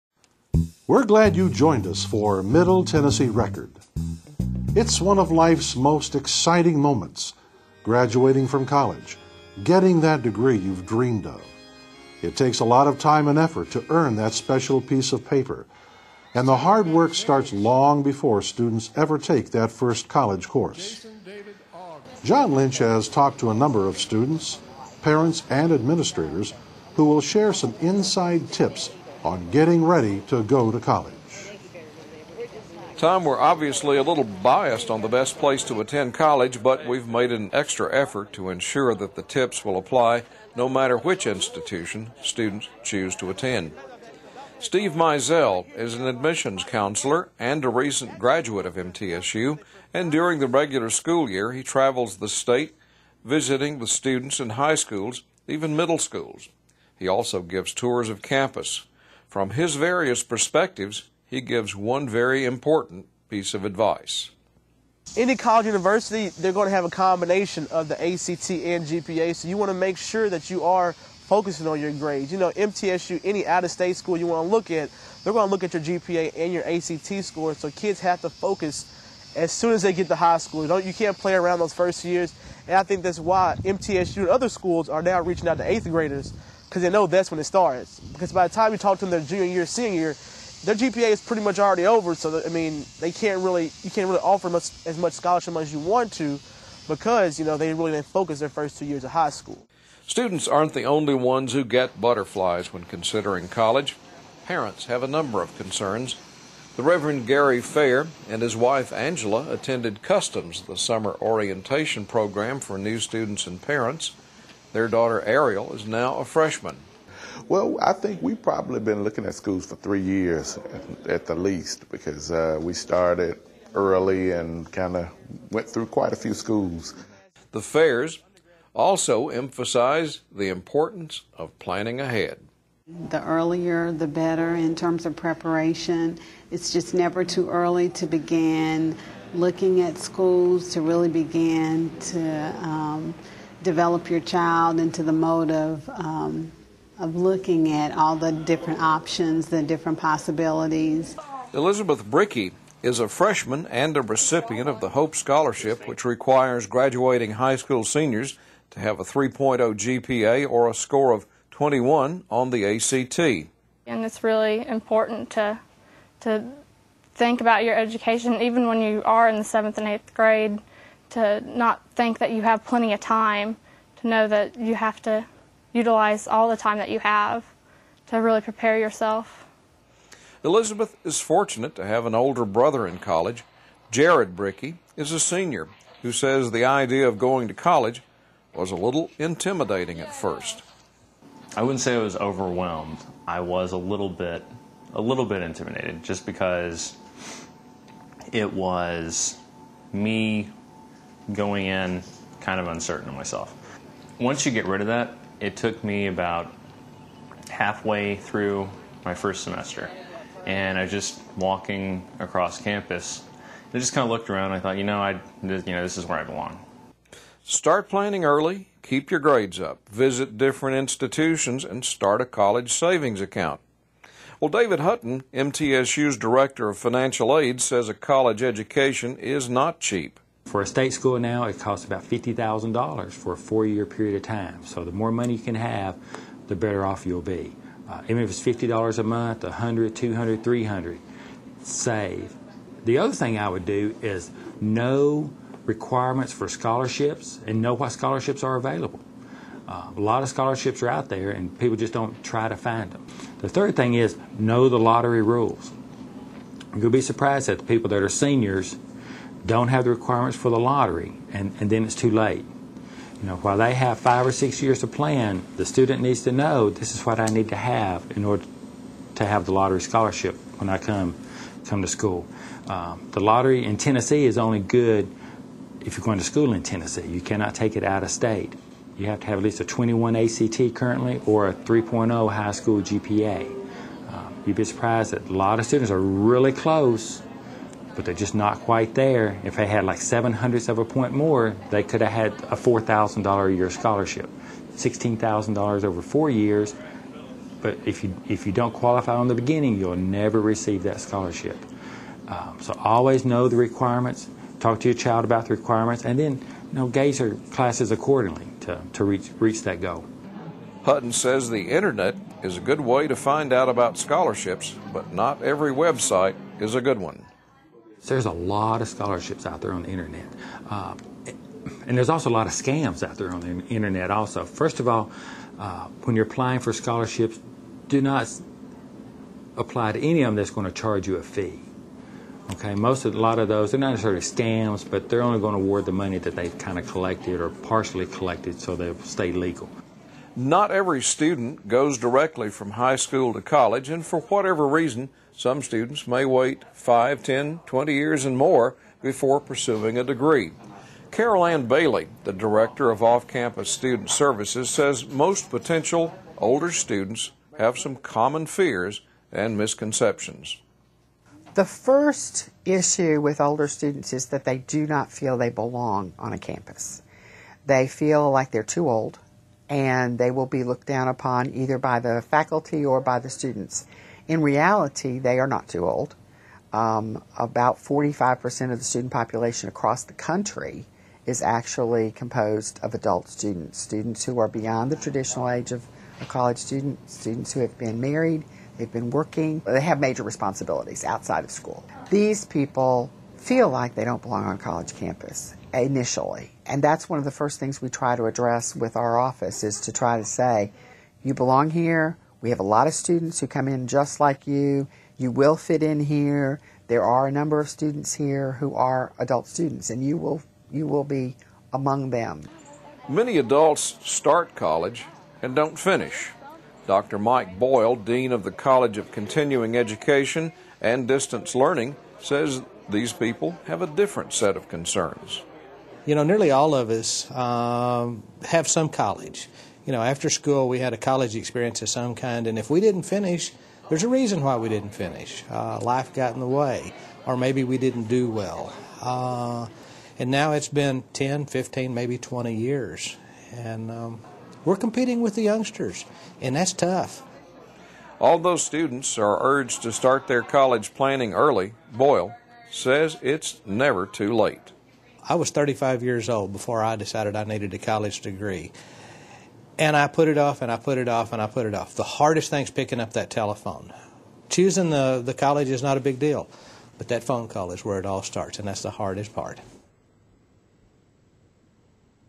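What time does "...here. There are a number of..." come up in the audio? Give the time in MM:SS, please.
06:45.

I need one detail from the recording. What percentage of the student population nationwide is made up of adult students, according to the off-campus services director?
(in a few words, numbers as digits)
45%.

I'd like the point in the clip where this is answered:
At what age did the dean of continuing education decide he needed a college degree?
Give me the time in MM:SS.
07:35.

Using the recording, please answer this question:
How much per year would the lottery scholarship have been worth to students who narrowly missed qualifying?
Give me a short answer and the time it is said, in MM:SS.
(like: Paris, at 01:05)
$4,000, at 04:52.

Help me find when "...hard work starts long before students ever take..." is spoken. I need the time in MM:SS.
00:16.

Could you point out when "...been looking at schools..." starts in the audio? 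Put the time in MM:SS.
01:58.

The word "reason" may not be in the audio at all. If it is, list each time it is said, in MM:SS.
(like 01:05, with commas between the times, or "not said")
05:44, 07:14.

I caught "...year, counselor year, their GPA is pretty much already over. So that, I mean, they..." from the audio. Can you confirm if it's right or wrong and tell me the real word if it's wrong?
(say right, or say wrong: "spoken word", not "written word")
wrong: "senior", not "counselor".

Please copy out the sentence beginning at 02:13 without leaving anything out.
The earlier, the better in terms of preparation.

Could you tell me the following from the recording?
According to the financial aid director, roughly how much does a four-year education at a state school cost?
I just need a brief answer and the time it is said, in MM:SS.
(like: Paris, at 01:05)
$50,000, at 03:52.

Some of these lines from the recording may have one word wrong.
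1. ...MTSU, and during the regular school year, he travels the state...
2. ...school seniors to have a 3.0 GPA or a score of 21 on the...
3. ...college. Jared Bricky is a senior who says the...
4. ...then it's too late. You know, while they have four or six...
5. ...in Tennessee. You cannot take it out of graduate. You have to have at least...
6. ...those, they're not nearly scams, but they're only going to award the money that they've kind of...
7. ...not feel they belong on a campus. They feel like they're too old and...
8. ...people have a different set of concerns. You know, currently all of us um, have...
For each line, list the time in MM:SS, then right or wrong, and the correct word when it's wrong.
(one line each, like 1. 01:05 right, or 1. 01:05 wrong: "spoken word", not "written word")
1. 00:48 right
2. 02:37 right
3. 03:02 right
4. 04:21 wrong: "five", not "four"
5. 04:36 wrong: "state", not "graduate"
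6. 05:33 wrong: "necessarily", not "nearly"
7. 06:04 right
8. 07:03 wrong: "nearly", not "currently".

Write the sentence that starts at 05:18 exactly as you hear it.
So there's a lot of scholarships out there on the internet.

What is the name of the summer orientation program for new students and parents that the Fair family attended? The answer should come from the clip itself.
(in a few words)
Customs.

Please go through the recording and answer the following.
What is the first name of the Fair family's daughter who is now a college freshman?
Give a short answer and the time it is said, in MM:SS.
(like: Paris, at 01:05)
Ariel, at 01:55.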